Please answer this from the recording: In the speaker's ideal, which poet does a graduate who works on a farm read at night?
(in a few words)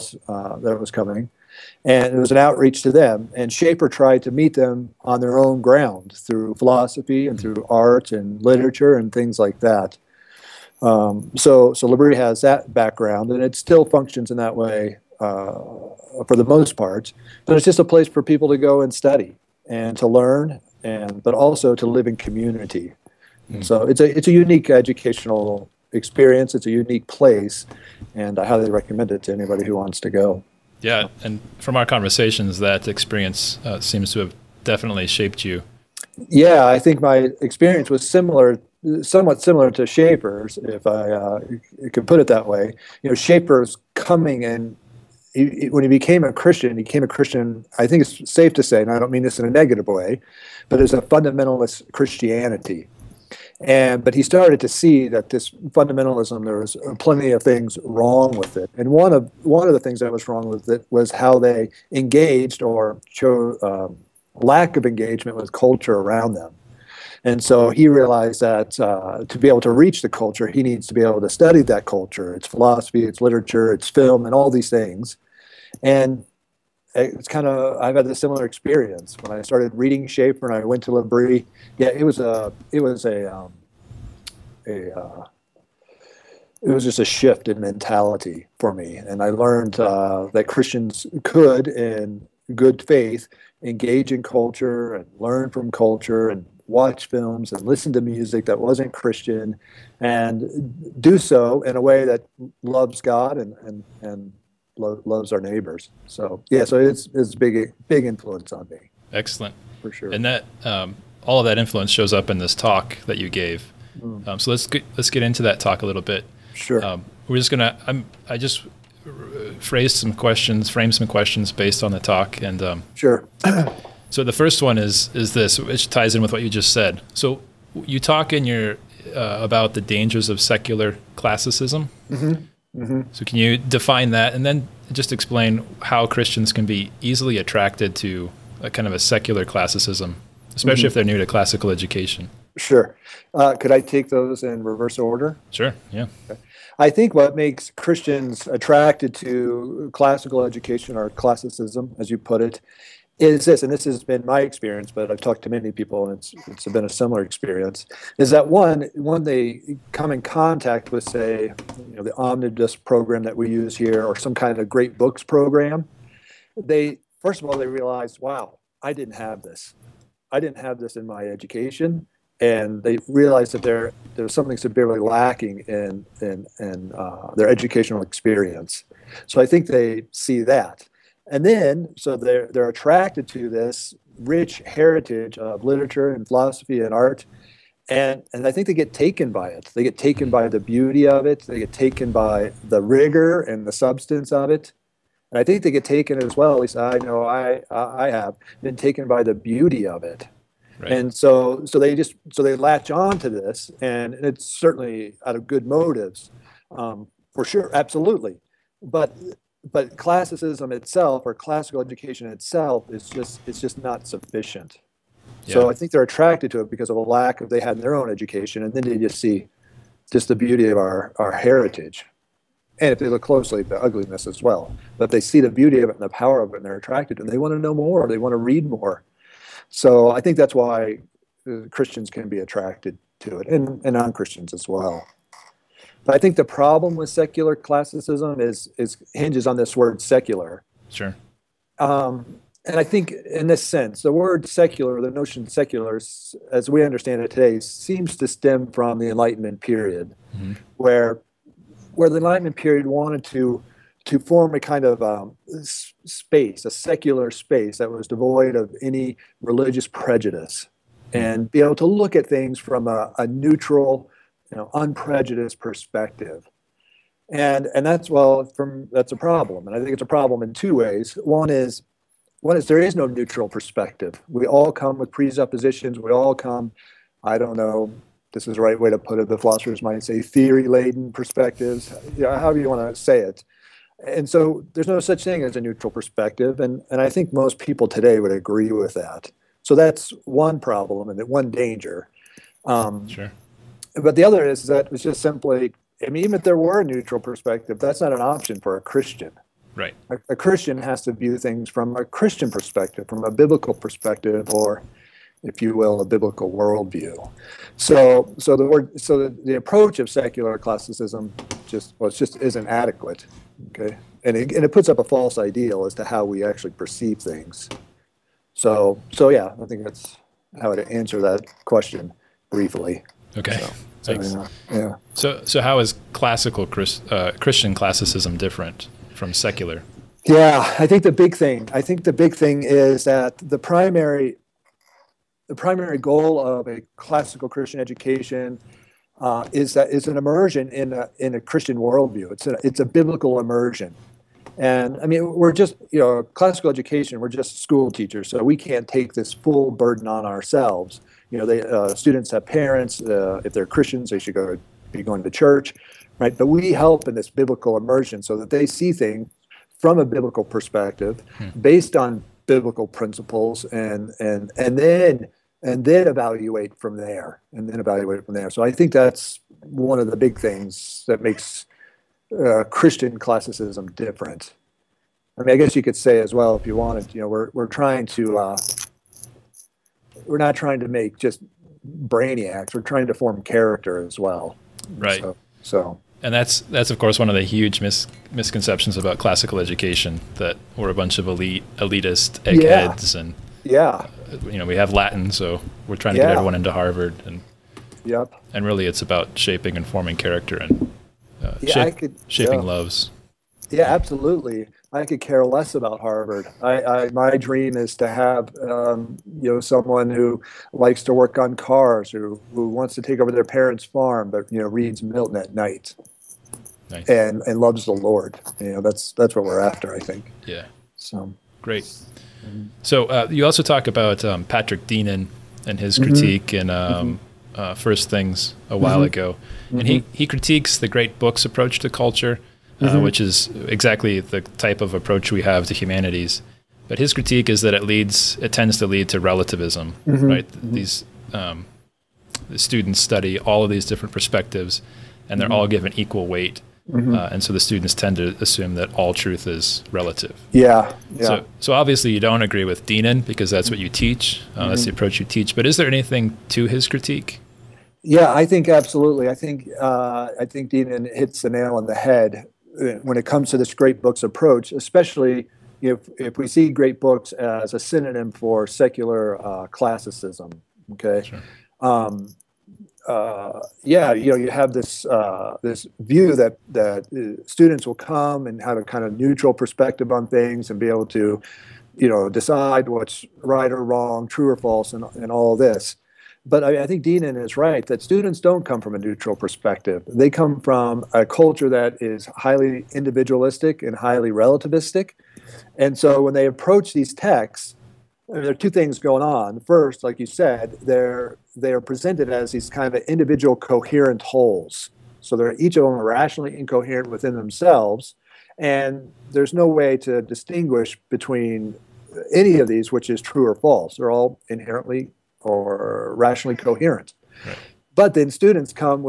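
Milton.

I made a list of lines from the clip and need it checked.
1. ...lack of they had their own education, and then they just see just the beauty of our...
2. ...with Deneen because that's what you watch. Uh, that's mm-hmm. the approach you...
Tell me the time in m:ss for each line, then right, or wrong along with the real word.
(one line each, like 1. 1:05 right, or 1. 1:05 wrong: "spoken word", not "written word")
1. 3:36 right
2. 7:32 wrong: "teach", not "watch".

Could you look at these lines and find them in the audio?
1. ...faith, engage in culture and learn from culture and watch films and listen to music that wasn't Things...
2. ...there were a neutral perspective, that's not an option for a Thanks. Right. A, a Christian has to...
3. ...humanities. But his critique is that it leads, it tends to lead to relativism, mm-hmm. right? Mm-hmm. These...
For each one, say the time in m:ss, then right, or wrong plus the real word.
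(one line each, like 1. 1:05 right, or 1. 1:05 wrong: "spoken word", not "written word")
1. 1:32 wrong: "Christian", not "Things"
2. 4:56 wrong: "Christian", not "Thanks"
3. 7:15 right.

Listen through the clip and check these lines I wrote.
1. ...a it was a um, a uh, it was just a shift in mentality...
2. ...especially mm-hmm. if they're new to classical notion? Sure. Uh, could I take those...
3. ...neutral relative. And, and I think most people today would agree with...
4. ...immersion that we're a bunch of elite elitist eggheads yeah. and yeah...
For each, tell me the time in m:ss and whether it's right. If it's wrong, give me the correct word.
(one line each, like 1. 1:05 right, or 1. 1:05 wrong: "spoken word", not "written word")
1. 1:22 right
2. 2:20 wrong: "education", not "notion"
3. 4:45 wrong: "perspective", not "relative"
4. 6:29 wrong: "education", not "immersion".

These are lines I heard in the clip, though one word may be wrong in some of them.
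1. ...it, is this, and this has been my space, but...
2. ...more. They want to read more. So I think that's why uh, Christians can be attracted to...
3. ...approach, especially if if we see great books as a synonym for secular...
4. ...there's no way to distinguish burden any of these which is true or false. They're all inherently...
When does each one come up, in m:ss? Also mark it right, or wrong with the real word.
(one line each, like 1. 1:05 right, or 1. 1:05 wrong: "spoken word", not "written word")
1. 2:32 wrong: "experience", not "space"
2. 3:47 right
3. 7:44 right
4. 8:29 wrong: "between", not "burden".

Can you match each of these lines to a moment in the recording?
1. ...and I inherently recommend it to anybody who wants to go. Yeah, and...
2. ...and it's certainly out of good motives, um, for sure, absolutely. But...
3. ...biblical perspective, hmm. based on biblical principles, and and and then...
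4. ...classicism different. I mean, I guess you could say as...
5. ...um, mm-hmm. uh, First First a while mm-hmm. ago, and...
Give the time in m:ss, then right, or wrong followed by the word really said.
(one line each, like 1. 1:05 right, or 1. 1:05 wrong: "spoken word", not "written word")
1. 0:28 wrong: "highly", not "inherently"
2. 3:23 right
3. 6:00 right
4. 6:13 right
5. 7:06 wrong: "Things", not "First".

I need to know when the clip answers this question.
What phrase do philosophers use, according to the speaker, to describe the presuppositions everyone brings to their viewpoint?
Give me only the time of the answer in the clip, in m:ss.
4:40.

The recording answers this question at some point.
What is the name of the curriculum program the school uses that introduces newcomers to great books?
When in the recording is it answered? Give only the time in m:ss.
2:42.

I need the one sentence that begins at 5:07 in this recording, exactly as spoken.
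So, so the word, so the, the approach of secular classicism just well, it just isn't adequate.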